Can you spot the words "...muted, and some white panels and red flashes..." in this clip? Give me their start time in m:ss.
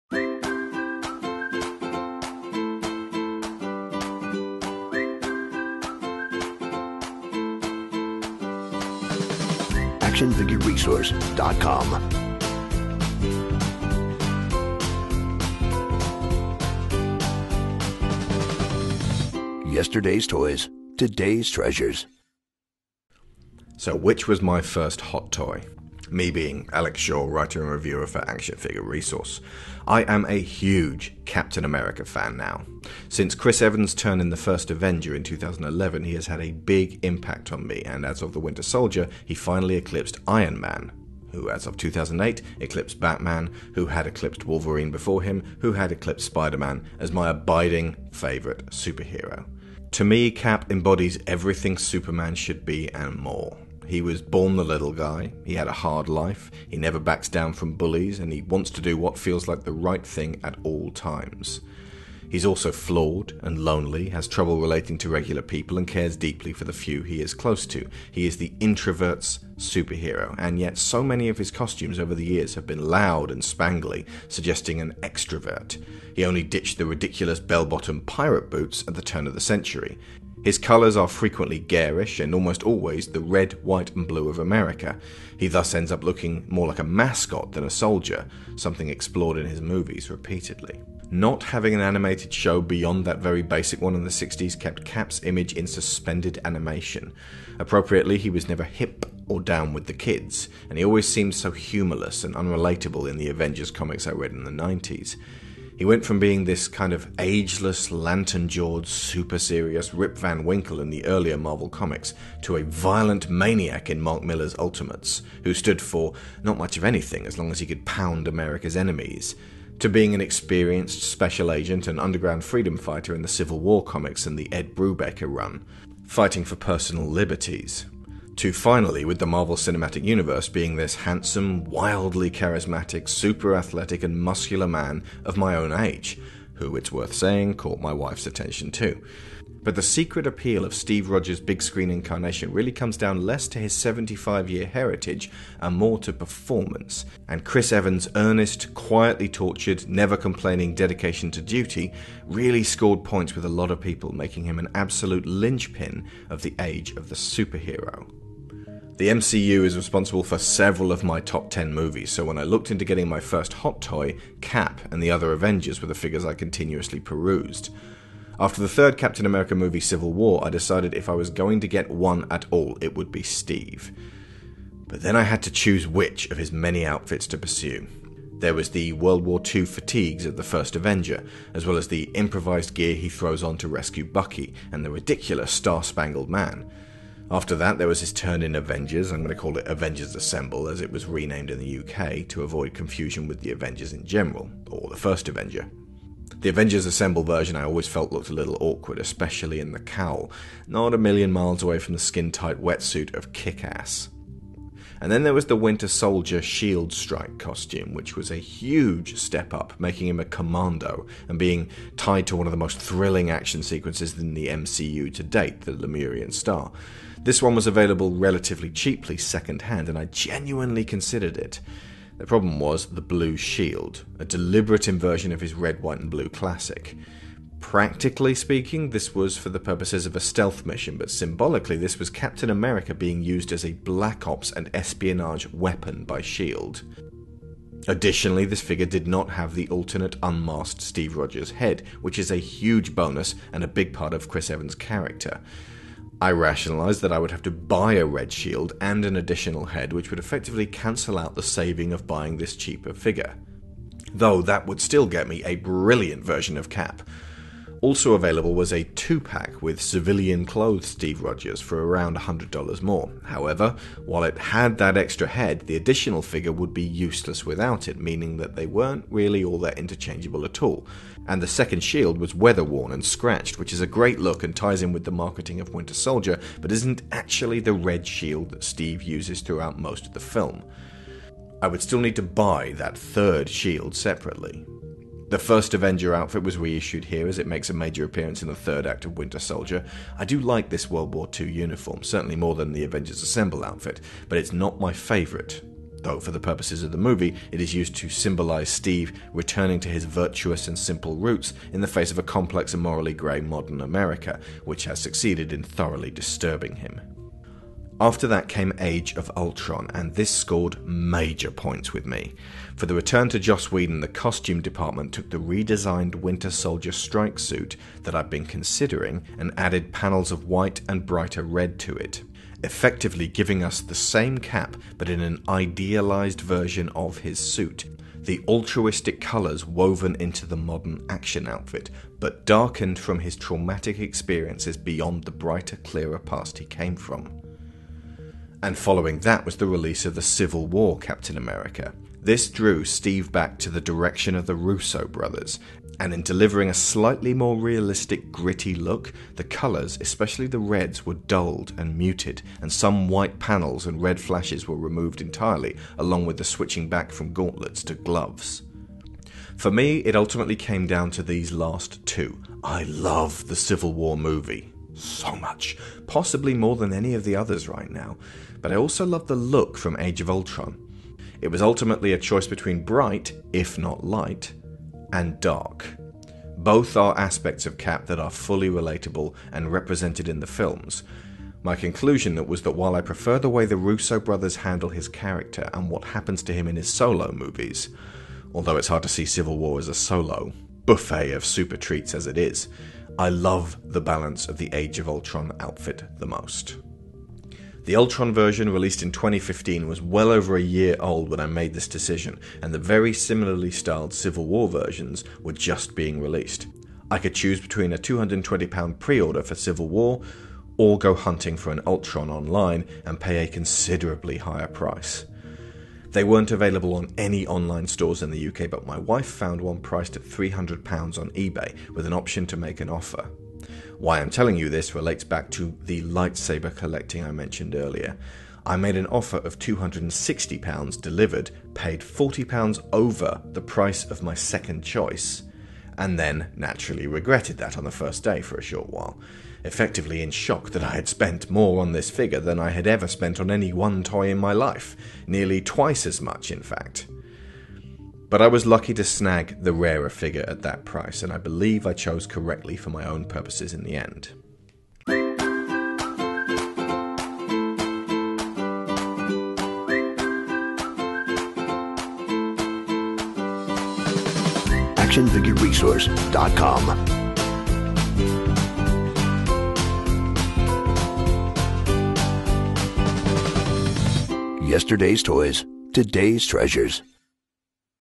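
5:51.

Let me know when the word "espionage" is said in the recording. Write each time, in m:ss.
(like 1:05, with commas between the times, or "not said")
3:54.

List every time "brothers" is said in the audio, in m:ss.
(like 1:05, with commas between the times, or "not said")
5:45, 6:24.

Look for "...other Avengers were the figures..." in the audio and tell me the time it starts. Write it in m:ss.
2:45.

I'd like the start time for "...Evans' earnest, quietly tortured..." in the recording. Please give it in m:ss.
2:27.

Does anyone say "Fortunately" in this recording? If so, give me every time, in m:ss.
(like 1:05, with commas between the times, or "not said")
not said.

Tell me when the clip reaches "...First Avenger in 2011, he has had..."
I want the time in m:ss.
0:34.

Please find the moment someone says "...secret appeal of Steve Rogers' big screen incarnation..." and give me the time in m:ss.
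2:19.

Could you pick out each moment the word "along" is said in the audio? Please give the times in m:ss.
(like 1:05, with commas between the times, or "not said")
5:55.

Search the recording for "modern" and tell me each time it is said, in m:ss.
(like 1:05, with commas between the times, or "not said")
5:03, 5:30.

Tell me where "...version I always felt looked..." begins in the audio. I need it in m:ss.
3:17.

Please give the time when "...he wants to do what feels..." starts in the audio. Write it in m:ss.
0:58.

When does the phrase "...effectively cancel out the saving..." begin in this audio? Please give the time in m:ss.
4:10.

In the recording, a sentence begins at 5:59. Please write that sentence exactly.
For me, it ultimately came down to these last two.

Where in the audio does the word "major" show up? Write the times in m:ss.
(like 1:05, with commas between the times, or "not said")
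4:47, 5:10.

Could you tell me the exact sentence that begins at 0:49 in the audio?
To me, Cap embodies everything Superman should be and more.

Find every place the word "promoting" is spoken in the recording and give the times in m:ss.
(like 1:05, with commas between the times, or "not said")
not said.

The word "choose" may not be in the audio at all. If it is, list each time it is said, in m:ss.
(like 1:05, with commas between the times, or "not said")
2:55, 6:47.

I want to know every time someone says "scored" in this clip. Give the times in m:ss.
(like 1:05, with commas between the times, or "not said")
2:32, 5:10.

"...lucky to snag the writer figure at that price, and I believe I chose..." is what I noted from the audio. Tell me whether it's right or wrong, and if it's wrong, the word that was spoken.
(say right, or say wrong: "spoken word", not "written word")
wrong: "rarer", not "writer".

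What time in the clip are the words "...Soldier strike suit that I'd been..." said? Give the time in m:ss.
5:16.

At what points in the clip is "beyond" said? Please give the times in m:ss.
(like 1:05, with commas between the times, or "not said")
1:32, 5:34.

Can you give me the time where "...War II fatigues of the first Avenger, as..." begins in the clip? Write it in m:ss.
2:59.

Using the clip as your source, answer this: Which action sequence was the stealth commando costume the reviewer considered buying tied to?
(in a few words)
the Lemurian Star.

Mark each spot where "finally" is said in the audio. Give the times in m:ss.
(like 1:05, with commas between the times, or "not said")
0:39, 2:08.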